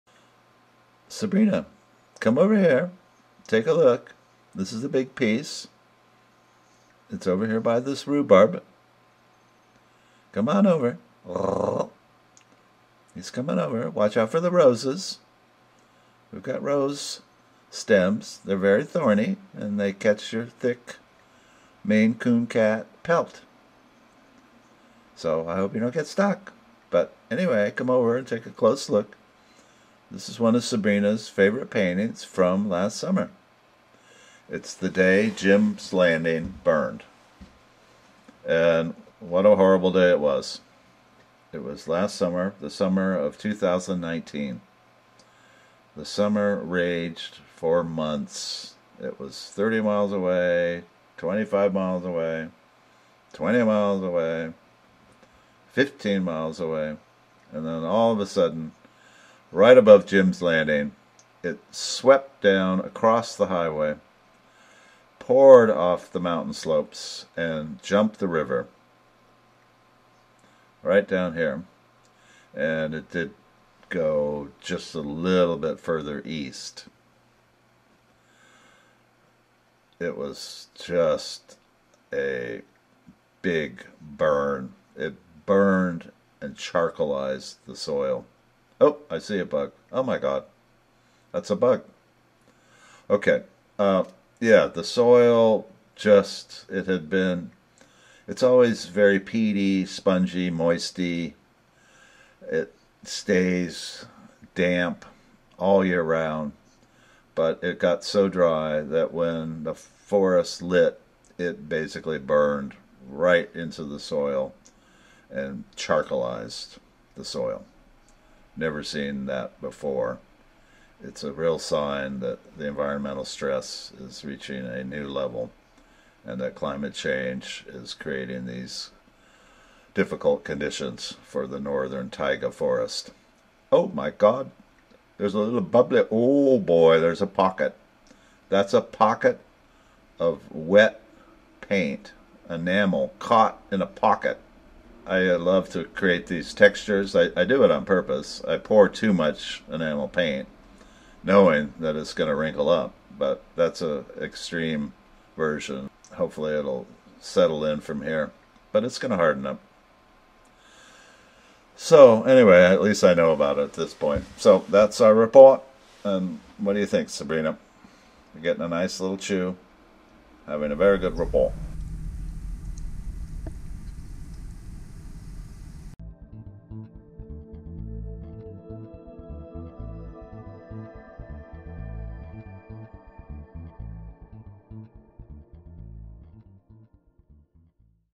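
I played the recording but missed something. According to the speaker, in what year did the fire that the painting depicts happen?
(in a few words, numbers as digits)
2019.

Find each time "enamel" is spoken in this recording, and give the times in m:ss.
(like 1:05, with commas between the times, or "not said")
2:22, 2:29.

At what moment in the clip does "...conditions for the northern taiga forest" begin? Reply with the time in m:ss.
2:10.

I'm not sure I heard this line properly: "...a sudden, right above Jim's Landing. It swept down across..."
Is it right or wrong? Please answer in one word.
right.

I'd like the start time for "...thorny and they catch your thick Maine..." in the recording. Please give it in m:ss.
0:18.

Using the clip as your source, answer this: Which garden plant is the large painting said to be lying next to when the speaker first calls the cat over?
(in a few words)
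Rhubarb.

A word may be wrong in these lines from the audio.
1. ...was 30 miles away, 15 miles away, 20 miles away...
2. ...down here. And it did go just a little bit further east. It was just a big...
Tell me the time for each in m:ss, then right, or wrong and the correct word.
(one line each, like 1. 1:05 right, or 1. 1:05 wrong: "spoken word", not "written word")
1. 0:49 wrong: "25", not "15"
2. 1:11 right.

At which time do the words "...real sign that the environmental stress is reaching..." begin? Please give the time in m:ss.
2:01.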